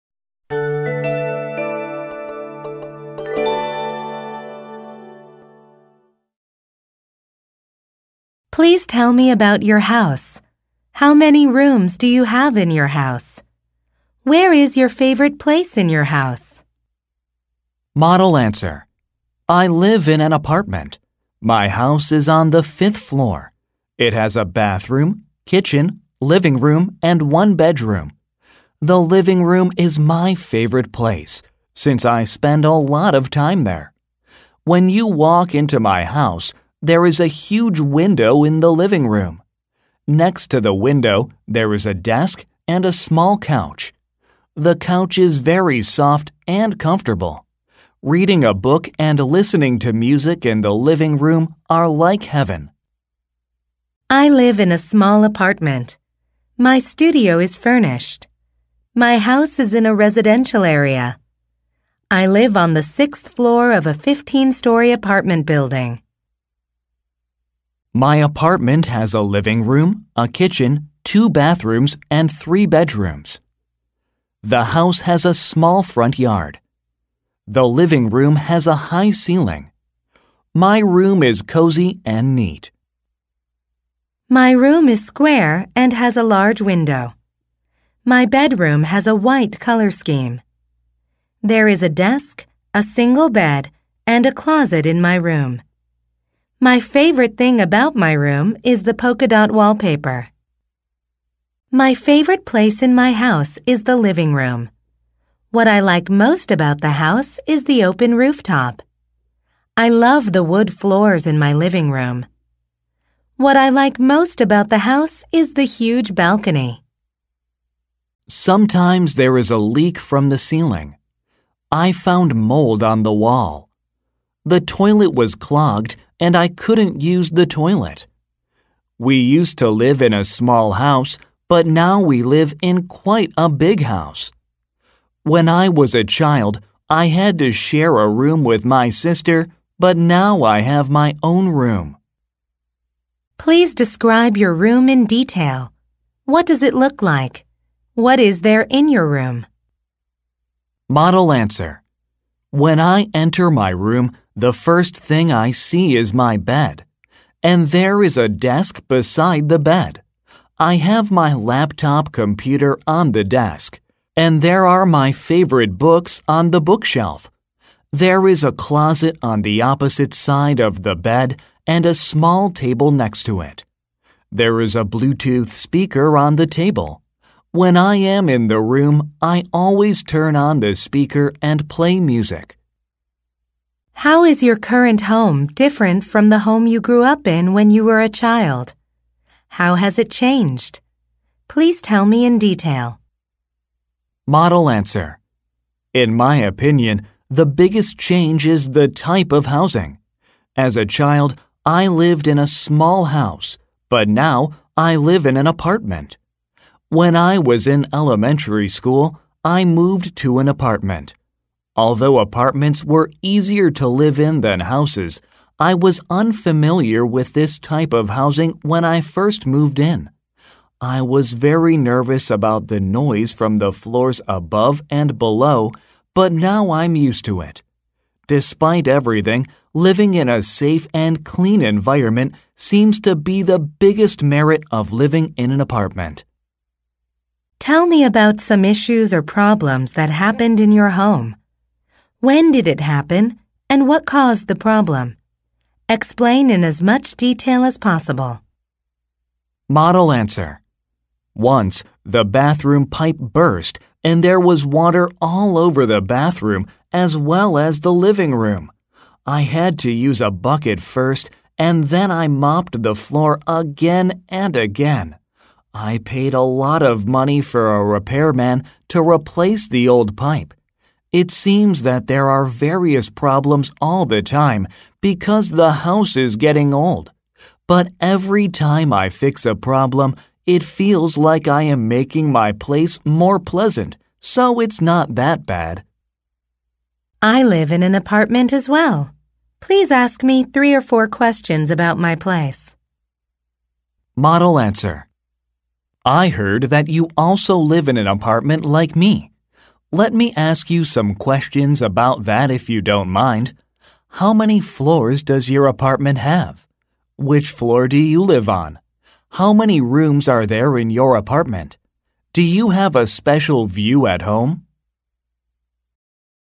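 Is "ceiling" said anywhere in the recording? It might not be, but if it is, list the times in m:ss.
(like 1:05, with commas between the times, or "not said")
1:19, 2:00.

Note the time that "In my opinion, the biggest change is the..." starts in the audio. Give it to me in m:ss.
3:15.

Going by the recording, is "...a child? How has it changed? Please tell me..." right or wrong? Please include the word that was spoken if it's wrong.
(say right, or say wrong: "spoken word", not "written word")
right.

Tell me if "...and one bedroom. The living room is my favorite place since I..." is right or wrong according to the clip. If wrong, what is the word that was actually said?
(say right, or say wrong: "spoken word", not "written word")
right.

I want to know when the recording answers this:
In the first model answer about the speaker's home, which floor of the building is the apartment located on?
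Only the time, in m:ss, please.
0:22.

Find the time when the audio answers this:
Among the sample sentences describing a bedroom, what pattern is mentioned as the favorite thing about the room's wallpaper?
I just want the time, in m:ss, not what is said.
1:38.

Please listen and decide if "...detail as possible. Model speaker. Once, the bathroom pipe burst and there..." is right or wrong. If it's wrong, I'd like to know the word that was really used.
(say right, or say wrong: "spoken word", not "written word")
wrong: "answer", not "speaker".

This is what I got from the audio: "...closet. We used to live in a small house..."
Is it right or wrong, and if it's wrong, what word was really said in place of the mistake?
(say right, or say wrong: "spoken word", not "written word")
wrong: "toilet", not "closet".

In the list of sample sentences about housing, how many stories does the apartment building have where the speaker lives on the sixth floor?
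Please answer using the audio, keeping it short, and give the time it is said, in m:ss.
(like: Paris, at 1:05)
15, at 1:03.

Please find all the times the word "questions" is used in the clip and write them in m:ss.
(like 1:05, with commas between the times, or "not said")
4:51, 5:01.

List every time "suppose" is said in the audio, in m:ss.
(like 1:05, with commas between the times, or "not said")
not said.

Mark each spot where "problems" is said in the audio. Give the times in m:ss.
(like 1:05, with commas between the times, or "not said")
3:59, 4:04, 4:33, 4:39.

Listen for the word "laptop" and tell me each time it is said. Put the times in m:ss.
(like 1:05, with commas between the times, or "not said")
2:41.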